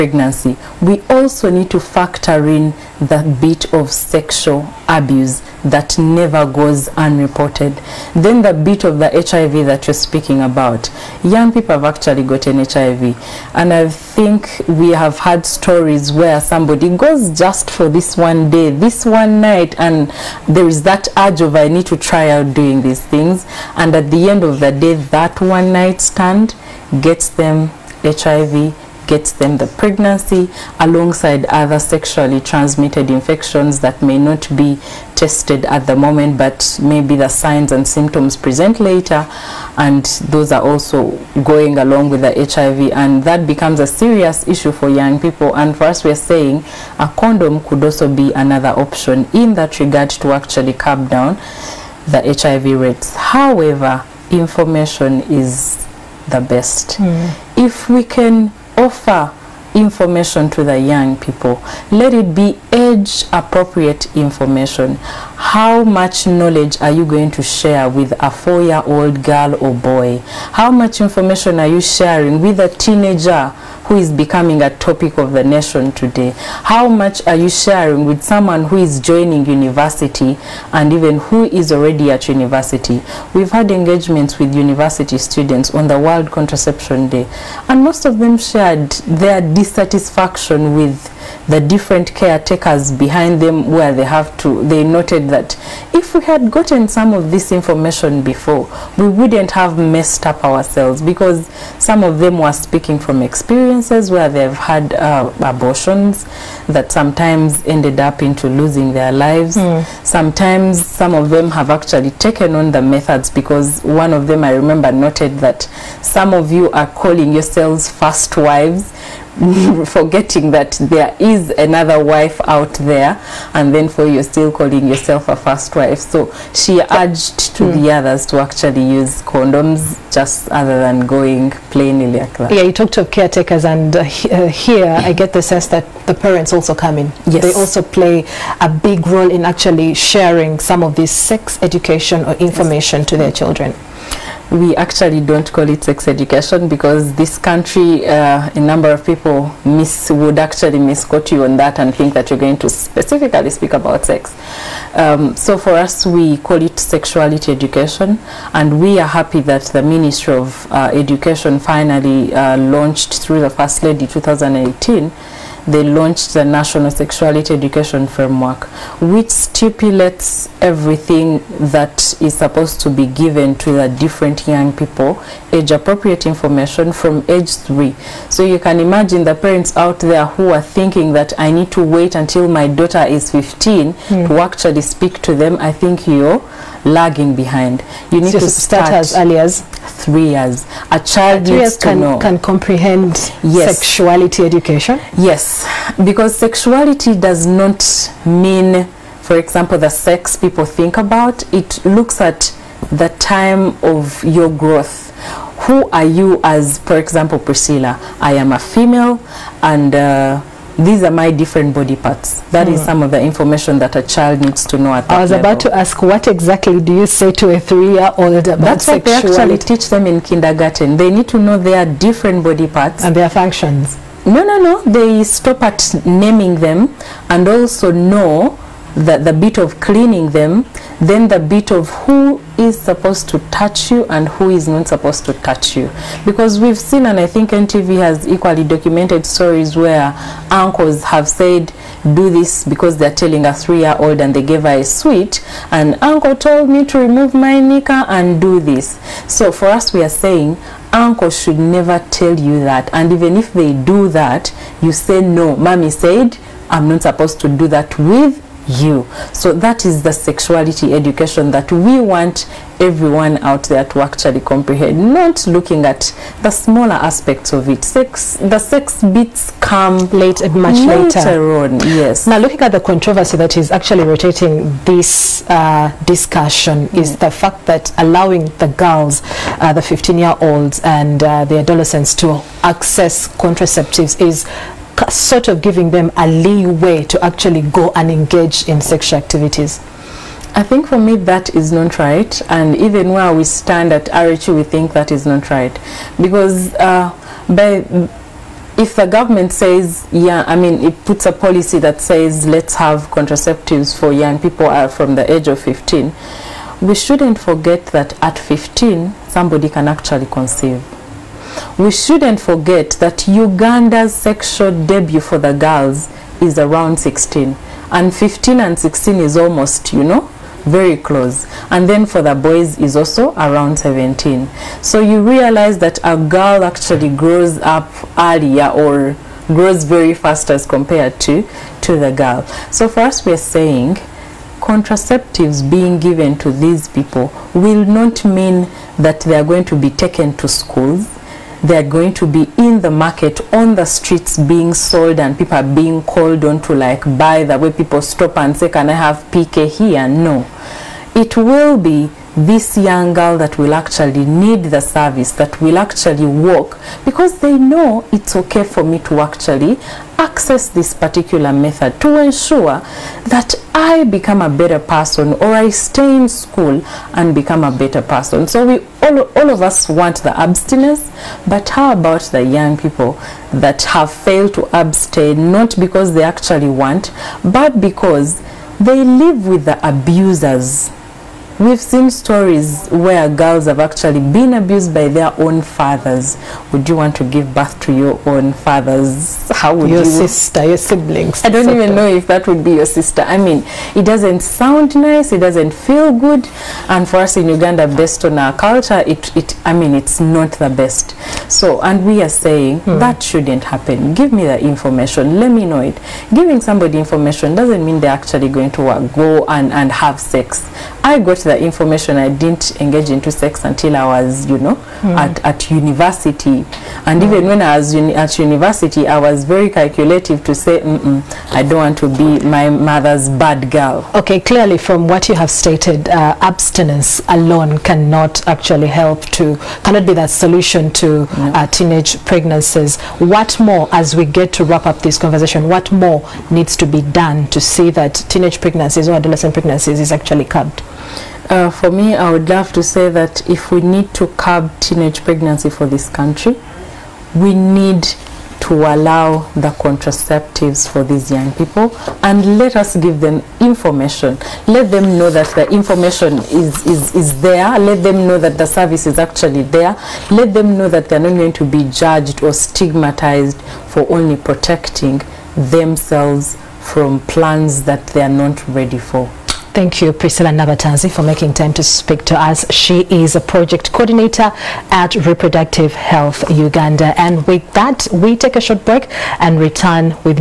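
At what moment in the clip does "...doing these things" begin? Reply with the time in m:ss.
0:22.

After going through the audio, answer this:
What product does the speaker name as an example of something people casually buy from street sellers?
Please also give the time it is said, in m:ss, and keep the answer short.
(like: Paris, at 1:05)
PK, at 5:49.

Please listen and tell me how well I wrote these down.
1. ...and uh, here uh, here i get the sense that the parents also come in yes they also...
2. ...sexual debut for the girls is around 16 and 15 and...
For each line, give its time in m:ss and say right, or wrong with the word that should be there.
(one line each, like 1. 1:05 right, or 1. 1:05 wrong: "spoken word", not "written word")
1. 2:13 right
2. 5:14 right.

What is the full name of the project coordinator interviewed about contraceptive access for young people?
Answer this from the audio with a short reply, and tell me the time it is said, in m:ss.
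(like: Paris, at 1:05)
Priscilla Nabatanzi, at 7:50.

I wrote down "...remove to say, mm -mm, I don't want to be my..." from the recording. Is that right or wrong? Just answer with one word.
wrong.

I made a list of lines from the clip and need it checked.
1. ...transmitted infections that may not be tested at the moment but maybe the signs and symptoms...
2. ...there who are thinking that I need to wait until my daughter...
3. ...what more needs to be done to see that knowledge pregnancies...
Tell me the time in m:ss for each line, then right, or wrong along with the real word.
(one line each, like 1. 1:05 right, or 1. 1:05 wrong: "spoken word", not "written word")
1. 0:32 right
2. 2:59 right
3. 7:15 wrong: "teenage", not "knowledge".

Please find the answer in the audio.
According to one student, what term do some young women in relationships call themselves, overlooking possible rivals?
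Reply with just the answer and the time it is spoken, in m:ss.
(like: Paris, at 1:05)
first wives, at 1:57.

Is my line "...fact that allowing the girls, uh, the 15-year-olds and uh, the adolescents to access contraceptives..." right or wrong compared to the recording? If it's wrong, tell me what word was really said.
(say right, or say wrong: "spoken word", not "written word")
right.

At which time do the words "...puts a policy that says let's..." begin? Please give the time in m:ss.
5:01.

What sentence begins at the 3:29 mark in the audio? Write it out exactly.
Uh, these are my different body parts.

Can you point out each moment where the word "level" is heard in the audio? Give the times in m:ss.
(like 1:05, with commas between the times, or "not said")
3:35.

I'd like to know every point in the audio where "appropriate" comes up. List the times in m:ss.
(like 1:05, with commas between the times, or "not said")
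1:03, 2:55.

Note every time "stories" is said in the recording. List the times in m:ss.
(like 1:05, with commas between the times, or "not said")
0:15, 3:59, 6:22.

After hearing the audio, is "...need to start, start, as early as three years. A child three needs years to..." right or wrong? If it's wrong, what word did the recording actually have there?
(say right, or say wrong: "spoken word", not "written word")
right.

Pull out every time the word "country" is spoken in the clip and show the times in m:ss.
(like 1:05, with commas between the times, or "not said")
2:27, 7:26.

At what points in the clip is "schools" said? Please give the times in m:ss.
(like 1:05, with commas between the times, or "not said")
5:40, 6:06.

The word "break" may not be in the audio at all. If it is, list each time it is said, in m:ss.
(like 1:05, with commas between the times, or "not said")
7:58.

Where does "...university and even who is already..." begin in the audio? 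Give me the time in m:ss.
1:19.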